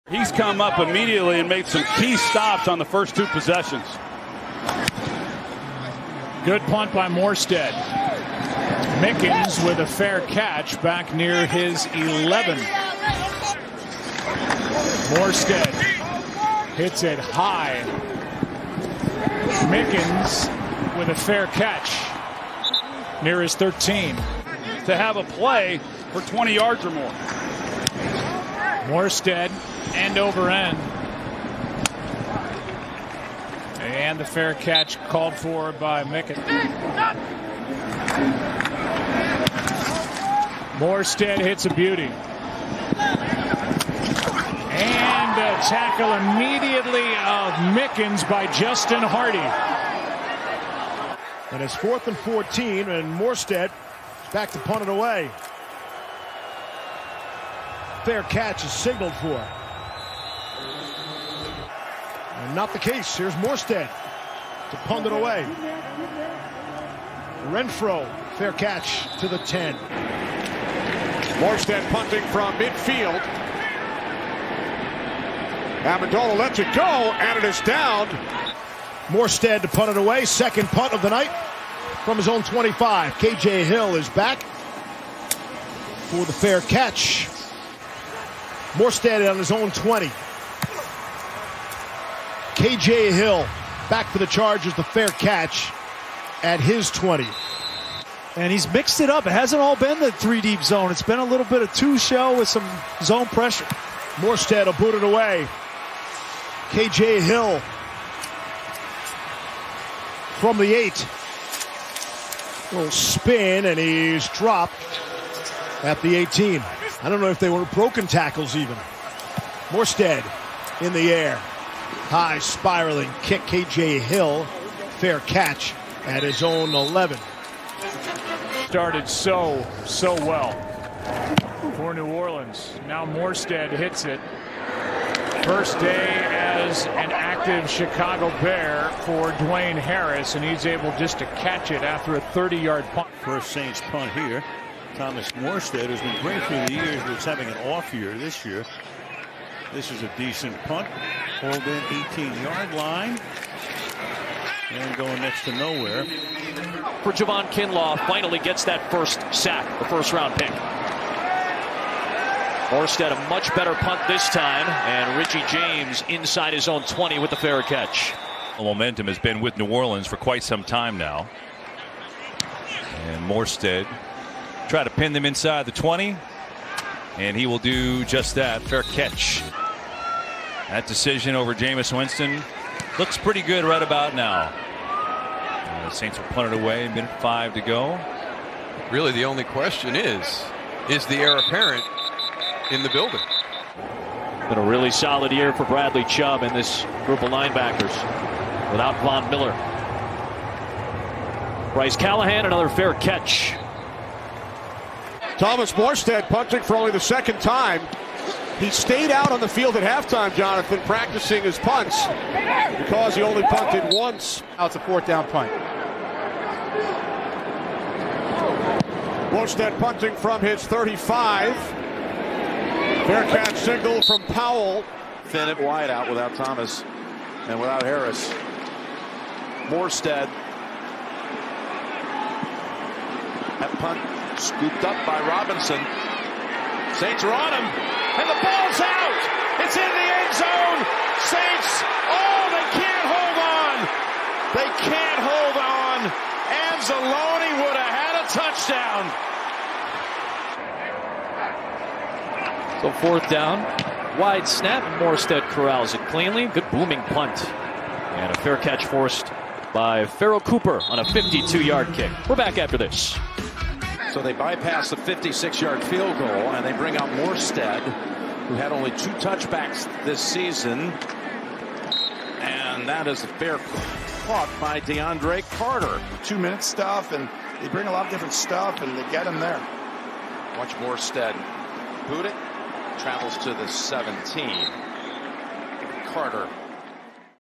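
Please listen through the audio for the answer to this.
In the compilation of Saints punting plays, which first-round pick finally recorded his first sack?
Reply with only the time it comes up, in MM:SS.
02:37.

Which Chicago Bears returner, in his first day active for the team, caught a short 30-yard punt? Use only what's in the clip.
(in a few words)
Dwayne Harris.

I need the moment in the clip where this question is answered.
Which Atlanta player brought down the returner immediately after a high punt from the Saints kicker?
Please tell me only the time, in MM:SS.
00:48.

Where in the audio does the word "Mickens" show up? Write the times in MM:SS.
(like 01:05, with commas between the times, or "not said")
00:09, 00:19, 00:36, 00:47.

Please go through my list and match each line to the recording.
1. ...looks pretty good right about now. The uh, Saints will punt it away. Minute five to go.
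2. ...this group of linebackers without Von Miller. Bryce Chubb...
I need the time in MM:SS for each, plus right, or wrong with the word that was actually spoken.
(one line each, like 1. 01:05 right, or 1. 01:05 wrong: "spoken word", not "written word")
1. 03:02 right
2. 03:16 wrong: "Callahan", not "Chubb".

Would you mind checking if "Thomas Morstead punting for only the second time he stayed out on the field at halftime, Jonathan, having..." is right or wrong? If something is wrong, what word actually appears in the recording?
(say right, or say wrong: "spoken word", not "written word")
wrong: "practicing", not "having".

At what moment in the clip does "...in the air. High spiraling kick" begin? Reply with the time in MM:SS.
02:00.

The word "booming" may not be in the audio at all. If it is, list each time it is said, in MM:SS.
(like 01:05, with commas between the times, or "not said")
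04:16.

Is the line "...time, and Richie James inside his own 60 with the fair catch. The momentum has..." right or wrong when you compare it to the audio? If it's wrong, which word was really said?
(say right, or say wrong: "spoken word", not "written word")
wrong: "20", not "60".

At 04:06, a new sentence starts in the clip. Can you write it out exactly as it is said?
Anzalone would have had a touchdown.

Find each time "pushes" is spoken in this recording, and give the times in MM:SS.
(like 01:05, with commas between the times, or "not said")
not said.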